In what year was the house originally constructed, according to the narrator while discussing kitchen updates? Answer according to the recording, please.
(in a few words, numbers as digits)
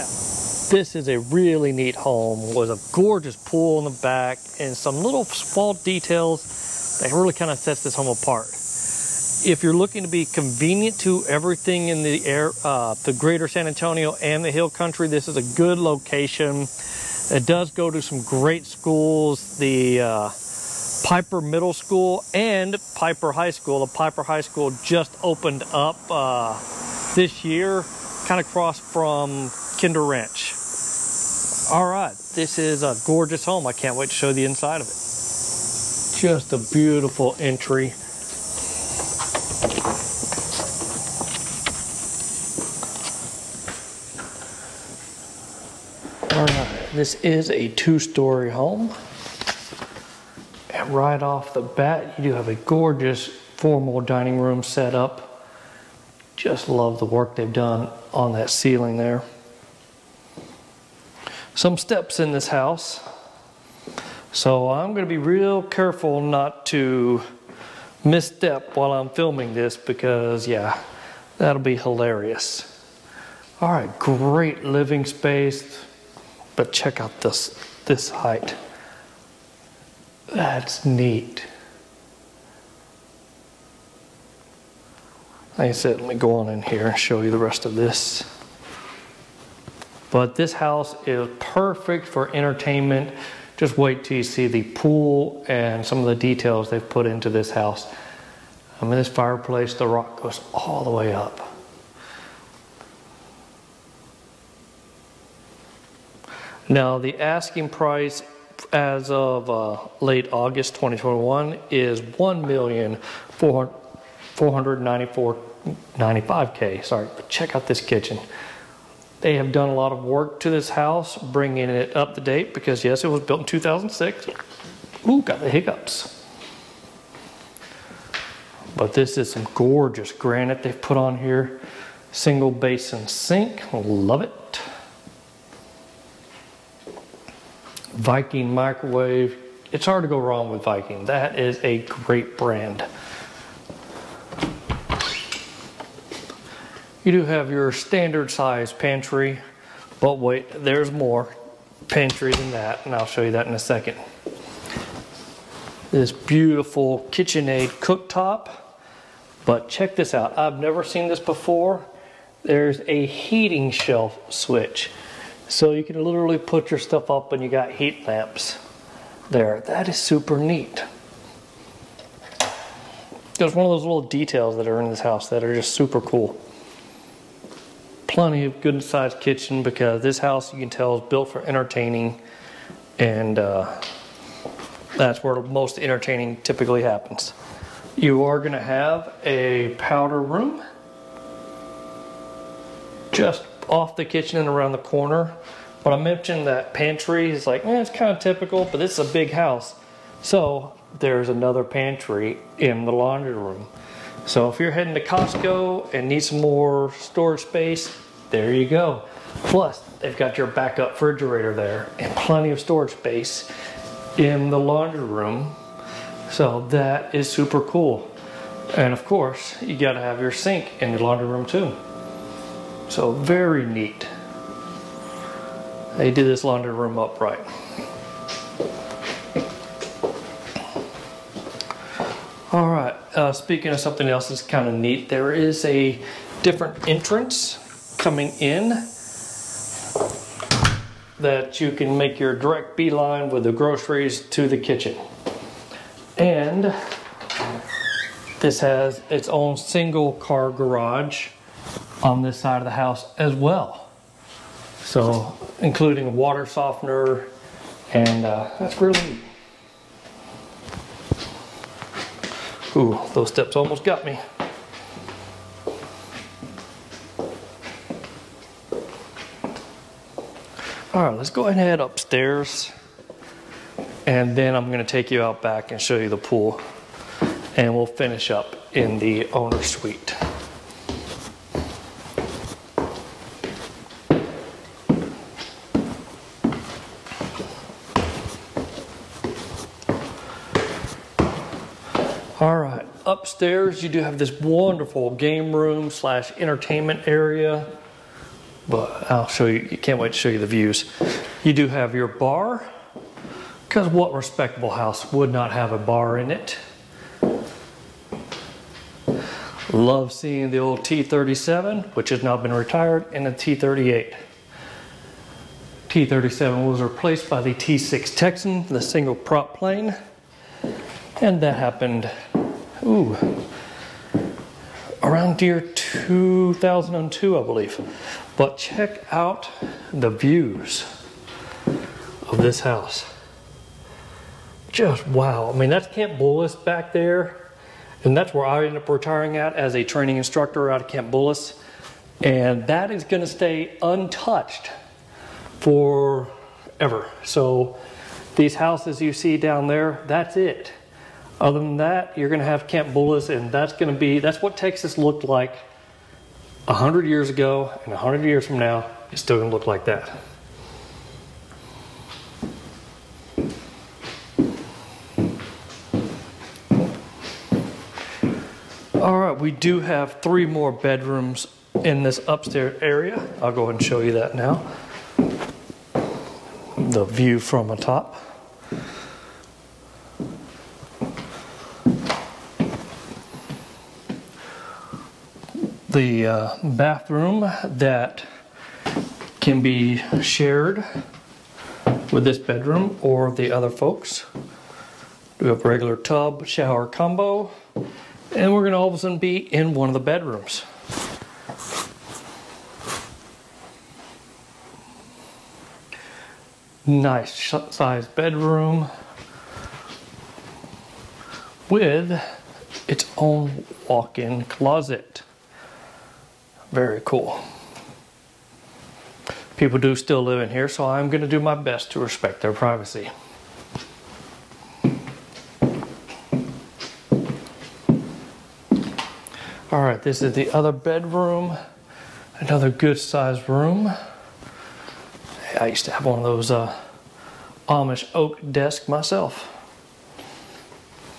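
2006.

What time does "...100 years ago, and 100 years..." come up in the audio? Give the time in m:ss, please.
5:56.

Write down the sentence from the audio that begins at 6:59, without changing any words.
People do still live in here, so I'm going to do my best to respect their privacy.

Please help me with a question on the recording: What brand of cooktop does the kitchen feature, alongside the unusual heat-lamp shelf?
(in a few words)
KitchenAid.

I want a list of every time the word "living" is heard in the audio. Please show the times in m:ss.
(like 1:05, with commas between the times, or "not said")
1:14.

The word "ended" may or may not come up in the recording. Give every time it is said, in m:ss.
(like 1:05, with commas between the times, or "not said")
5:38.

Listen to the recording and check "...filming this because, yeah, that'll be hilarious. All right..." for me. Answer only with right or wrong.
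right.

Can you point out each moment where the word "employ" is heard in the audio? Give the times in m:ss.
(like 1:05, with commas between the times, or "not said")
not said.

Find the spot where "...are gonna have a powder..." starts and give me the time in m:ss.
3:08.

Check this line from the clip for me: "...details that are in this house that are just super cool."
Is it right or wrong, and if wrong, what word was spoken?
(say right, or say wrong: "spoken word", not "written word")
right.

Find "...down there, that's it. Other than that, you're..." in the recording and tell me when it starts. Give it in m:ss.
5:49.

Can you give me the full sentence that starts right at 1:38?
I mean, this fireplace, the rock goes all the way up.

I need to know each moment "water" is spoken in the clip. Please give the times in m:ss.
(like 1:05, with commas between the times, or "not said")
4:16.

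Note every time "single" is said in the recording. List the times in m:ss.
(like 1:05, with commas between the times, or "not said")
2:12, 4:09, 5:18.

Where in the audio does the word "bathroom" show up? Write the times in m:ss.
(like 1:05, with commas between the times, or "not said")
6:26.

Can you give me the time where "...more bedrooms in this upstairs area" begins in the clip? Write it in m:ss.
6:10.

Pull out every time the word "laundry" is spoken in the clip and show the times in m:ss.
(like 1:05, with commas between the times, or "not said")
3:22, 3:34, 3:41, 3:46.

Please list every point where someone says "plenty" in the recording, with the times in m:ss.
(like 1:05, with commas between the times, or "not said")
2:58, 3:32.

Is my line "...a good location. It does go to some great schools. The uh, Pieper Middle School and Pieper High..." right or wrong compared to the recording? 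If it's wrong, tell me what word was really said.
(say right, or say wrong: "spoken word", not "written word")
right.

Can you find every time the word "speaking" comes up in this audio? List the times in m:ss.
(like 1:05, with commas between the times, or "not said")
3:53.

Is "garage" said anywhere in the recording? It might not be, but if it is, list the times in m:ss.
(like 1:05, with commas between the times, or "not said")
4:10.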